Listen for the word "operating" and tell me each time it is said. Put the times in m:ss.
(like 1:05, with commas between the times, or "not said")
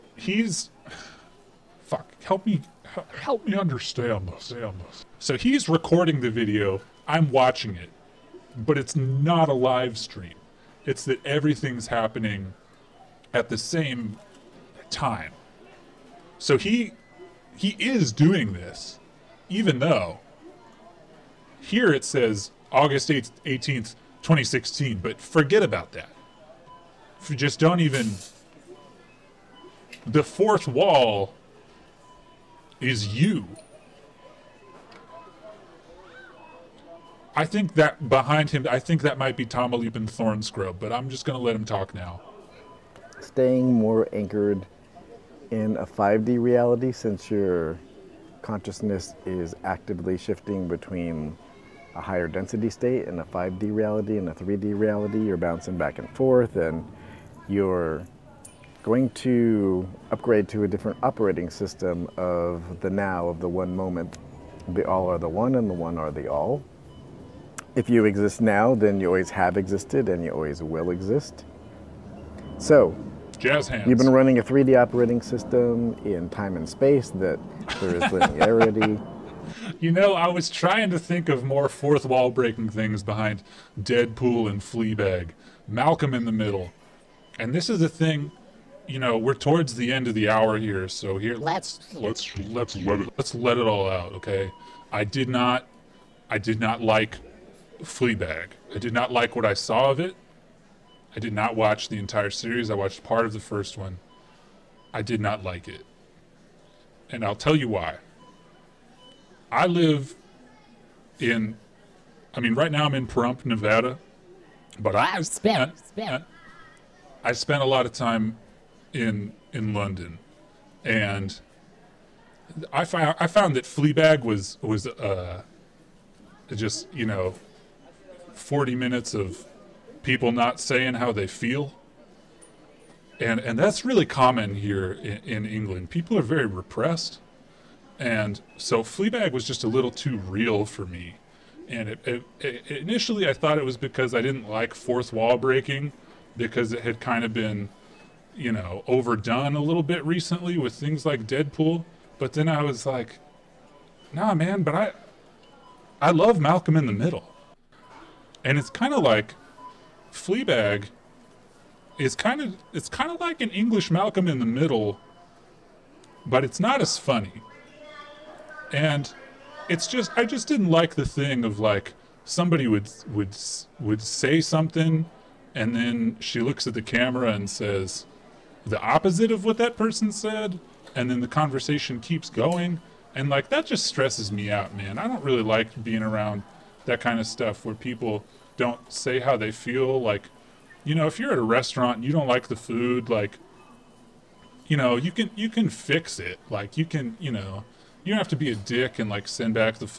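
1:01, 1:14.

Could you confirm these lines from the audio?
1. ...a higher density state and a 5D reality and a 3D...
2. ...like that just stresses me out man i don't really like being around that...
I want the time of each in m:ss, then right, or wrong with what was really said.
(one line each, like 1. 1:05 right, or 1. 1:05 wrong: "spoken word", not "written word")
1. 0:51 right
2. 3:03 right.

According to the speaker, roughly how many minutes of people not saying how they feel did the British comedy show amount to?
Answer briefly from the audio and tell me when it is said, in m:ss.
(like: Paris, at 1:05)
40, at 2:08.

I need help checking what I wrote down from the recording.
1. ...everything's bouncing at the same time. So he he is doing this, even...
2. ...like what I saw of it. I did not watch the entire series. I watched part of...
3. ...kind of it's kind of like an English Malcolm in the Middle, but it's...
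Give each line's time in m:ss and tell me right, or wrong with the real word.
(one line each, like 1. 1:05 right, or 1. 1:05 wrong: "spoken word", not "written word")
1. 0:11 wrong: "happening", not "bouncing"
2. 1:39 right
3. 2:42 right.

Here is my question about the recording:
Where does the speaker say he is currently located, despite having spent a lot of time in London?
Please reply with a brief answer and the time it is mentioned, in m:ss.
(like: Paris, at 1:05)
Pahrump, Nevada, at 1:53.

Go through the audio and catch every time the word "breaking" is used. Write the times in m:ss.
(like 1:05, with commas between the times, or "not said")
1:22, 2:25.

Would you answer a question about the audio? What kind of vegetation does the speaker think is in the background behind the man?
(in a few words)
Tamaulipan Thornscrub.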